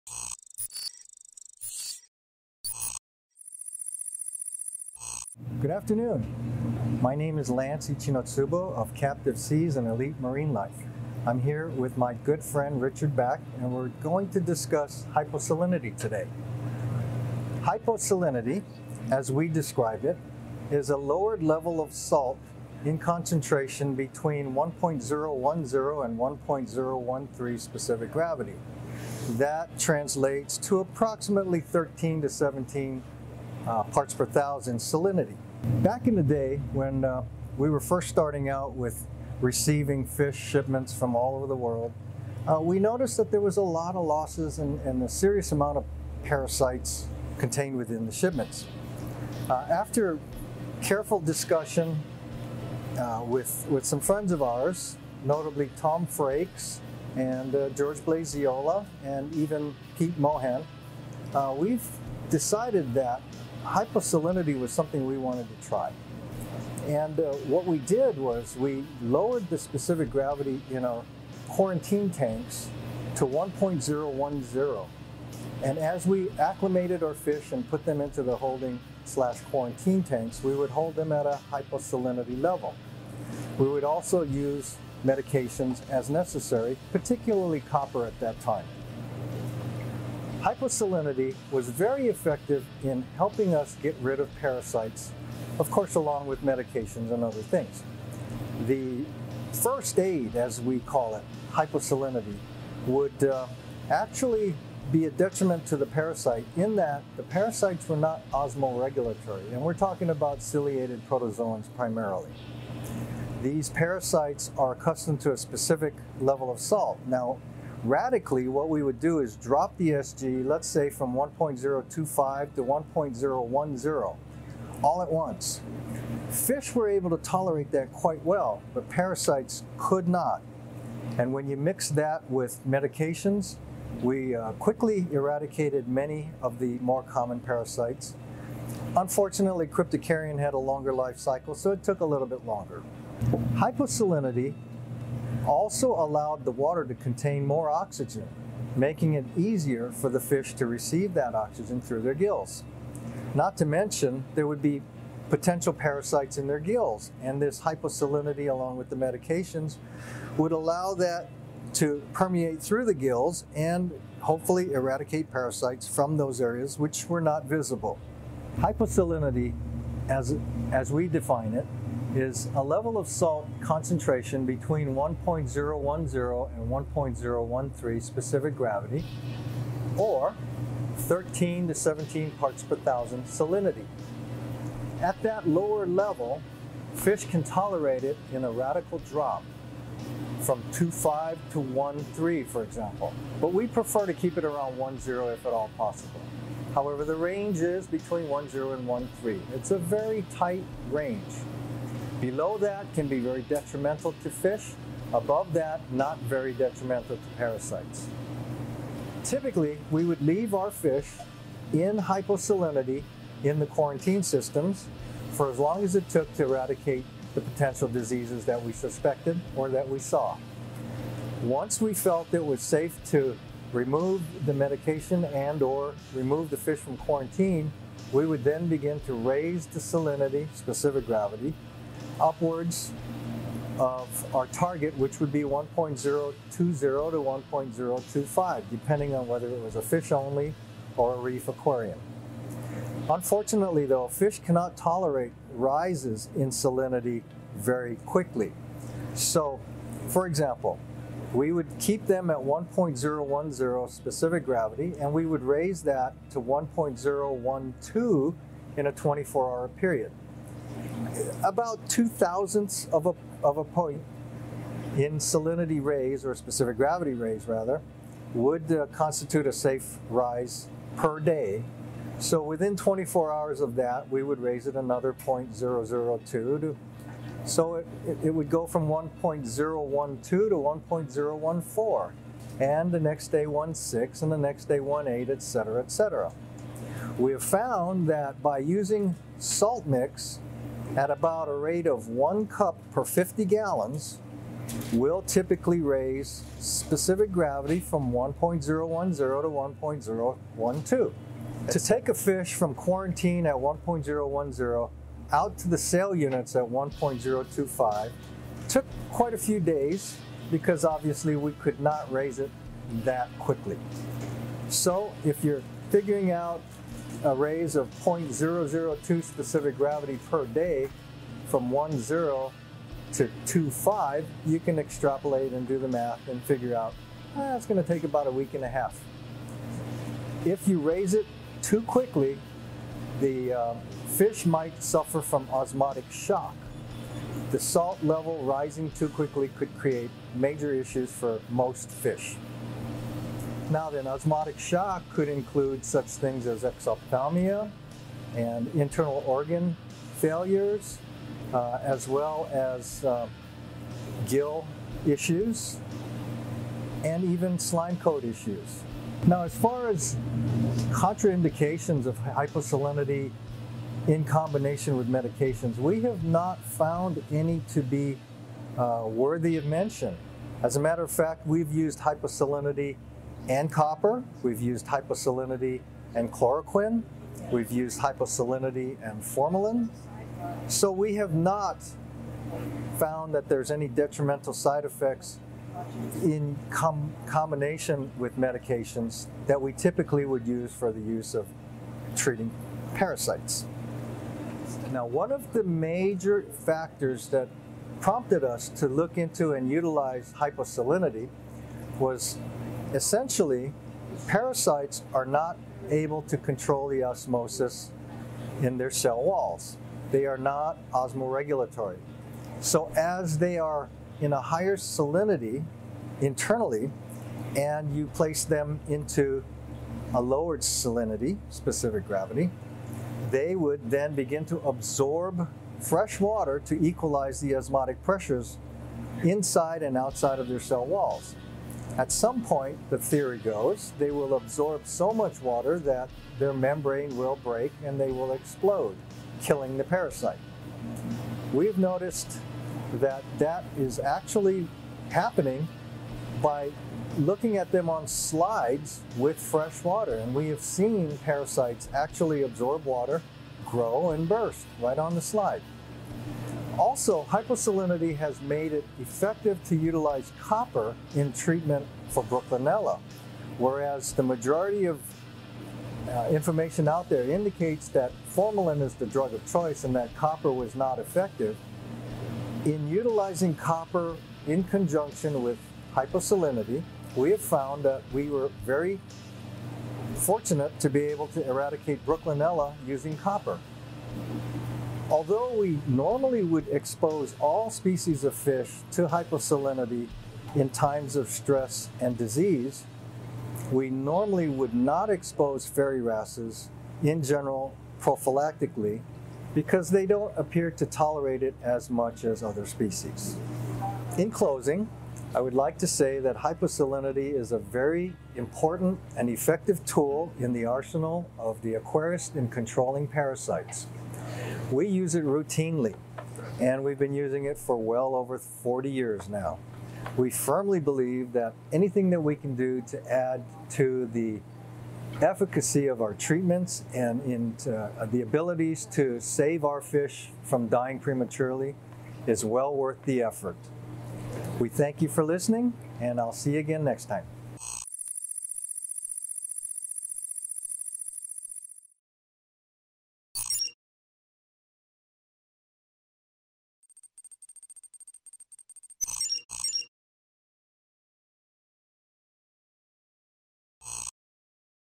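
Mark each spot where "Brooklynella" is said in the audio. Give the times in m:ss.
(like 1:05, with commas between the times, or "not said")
7:42, 8:02.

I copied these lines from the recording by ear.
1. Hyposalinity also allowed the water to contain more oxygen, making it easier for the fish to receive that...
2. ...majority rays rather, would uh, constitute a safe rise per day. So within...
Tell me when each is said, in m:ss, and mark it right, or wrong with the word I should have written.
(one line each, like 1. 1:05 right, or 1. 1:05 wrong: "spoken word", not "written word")
1. 2:23 right
2. 4:26 wrong: "gravity", not "majority".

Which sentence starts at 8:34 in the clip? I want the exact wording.
We use it routinely, and we've been using it for well over 40 years now.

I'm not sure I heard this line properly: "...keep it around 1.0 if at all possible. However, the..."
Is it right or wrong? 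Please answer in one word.
right.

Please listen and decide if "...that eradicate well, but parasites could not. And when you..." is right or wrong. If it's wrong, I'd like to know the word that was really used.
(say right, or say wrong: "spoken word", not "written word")
wrong: "quite", not "eradicate".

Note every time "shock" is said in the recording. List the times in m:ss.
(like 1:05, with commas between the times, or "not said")
5:36, 5:44.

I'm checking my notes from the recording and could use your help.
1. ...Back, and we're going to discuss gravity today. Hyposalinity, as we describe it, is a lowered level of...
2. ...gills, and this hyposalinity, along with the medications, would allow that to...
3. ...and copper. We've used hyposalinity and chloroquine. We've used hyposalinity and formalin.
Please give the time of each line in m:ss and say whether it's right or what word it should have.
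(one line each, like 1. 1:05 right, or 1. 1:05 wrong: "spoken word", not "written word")
1. 0:13 wrong: "hyposalinity", not "gravity"
2. 2:36 right
3. 6:13 right.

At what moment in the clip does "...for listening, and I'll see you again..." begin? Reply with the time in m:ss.
8:55.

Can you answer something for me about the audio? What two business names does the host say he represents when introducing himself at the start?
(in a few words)
Captive Seas and Elite Marinelife.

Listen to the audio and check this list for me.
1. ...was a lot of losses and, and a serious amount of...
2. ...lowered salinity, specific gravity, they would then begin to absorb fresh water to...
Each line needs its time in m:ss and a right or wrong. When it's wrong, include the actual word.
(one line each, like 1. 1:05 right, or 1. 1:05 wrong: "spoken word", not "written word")
1. 0:43 right
2. 7:00 right.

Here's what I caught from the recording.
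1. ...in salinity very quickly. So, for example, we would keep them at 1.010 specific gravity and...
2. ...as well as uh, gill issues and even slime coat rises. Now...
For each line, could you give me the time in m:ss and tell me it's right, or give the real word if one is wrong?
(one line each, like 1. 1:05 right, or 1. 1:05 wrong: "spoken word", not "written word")
1. 4:06 right
2. 5:51 wrong: "issues", not "rises".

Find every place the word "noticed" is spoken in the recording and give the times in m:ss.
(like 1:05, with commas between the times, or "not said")
0:42, 7:21.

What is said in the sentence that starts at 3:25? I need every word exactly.
Above that, not very detrimental to parasites.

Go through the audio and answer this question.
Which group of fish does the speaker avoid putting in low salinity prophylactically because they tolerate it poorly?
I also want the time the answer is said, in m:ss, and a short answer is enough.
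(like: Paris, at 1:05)
Fairy wrasses, at 8:15.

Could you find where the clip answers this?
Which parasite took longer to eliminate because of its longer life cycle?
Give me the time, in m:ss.
2:19.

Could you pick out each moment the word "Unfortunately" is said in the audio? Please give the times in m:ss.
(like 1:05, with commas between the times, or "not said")
2:18, 4:03.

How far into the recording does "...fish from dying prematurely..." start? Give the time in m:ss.
8:49.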